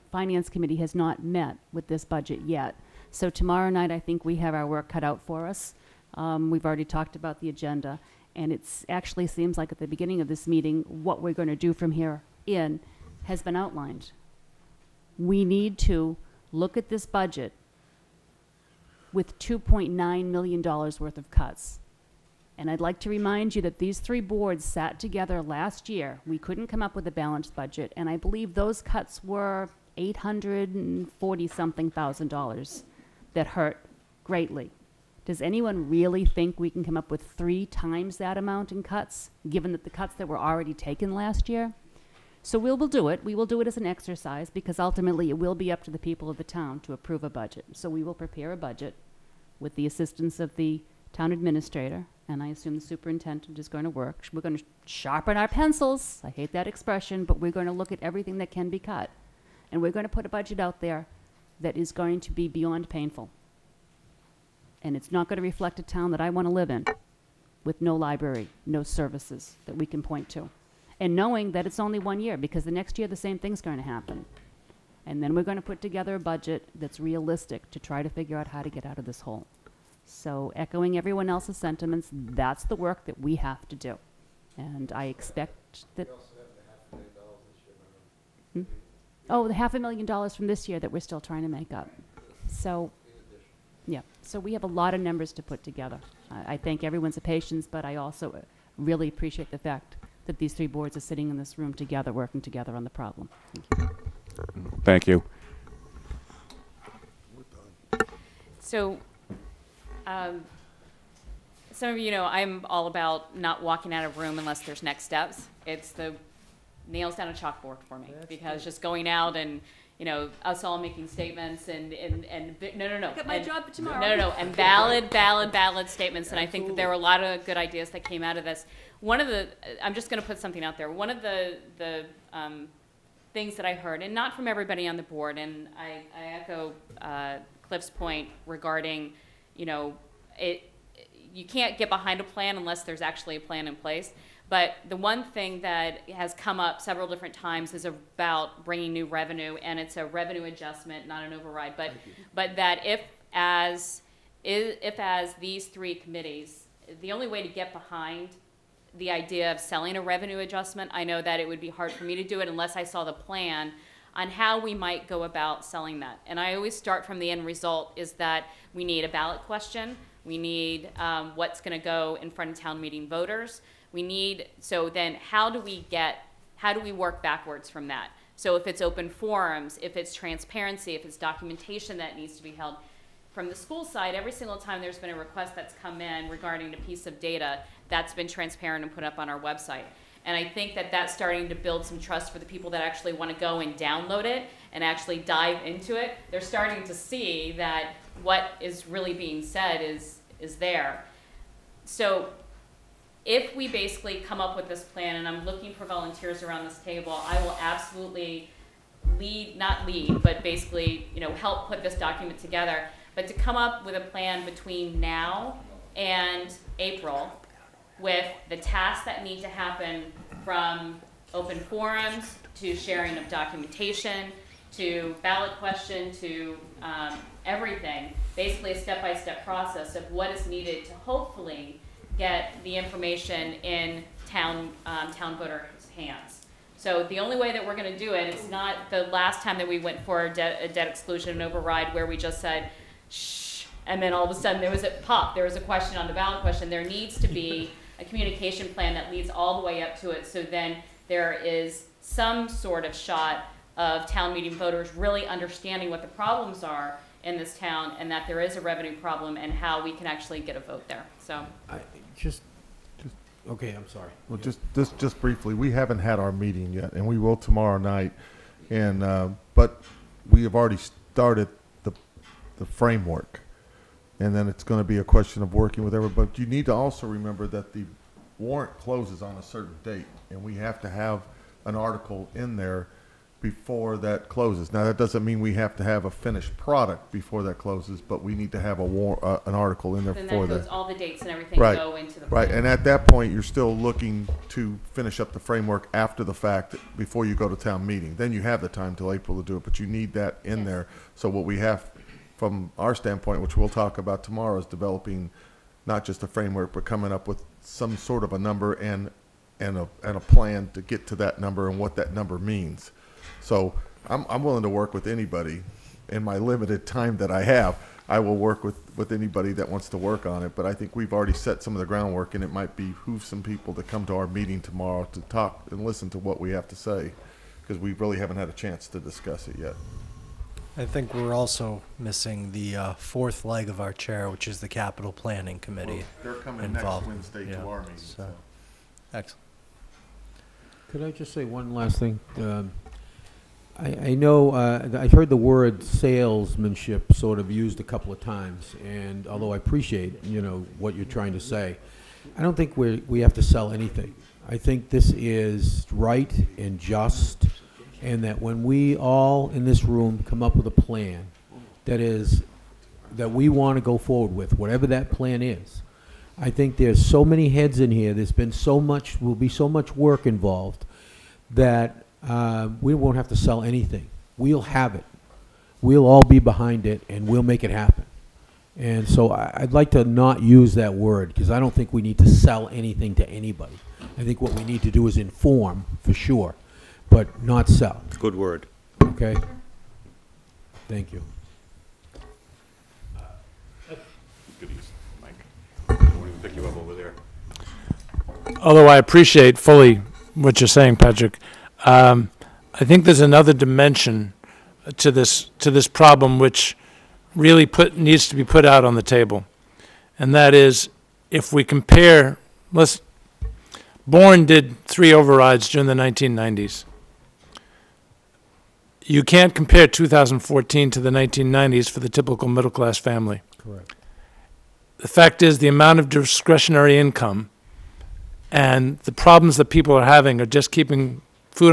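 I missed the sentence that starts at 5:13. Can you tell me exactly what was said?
So I'm, I'm willing to work with anybody in my limited time that I have.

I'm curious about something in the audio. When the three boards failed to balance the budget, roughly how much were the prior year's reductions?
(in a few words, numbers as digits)
840 thousand dollars.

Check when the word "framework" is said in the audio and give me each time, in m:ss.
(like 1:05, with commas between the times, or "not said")
4:32, 4:55, 5:06.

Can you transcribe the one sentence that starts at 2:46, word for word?
And I always start from the end result is that we need a ballot question.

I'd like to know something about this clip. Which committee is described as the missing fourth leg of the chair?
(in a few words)
Capital planning committee.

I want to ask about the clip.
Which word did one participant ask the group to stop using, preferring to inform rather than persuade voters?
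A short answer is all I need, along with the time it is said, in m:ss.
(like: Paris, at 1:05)
Salesmanship, at 5:45.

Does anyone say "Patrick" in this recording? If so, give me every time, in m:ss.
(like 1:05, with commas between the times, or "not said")
6:40.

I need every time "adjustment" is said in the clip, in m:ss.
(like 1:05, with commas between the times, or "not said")
2:30, 2:40.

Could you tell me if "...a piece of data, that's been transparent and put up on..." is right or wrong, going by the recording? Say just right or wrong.
right.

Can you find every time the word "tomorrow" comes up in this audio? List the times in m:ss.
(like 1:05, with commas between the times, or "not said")
0:03, 2:03, 4:27, 5:04, 5:24.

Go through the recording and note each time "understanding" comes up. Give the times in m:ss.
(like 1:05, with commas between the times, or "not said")
4:15.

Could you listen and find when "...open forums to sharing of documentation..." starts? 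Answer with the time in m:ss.
3:41.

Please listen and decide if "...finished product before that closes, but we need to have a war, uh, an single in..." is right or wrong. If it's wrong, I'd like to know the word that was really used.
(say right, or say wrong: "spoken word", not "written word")
wrong: "article", not "single".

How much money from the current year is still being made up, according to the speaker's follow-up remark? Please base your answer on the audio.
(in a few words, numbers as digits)
Half a million dollars.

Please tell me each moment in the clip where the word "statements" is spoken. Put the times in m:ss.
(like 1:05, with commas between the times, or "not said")
2:01, 2:05.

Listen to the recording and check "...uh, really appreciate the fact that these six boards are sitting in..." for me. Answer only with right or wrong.
wrong.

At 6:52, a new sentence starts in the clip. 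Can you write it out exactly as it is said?
Let's Bourne did three overrides during the 1990s.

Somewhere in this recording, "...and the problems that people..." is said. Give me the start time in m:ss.
7:08.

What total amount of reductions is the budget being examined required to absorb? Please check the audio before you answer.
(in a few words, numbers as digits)
$2.9 million.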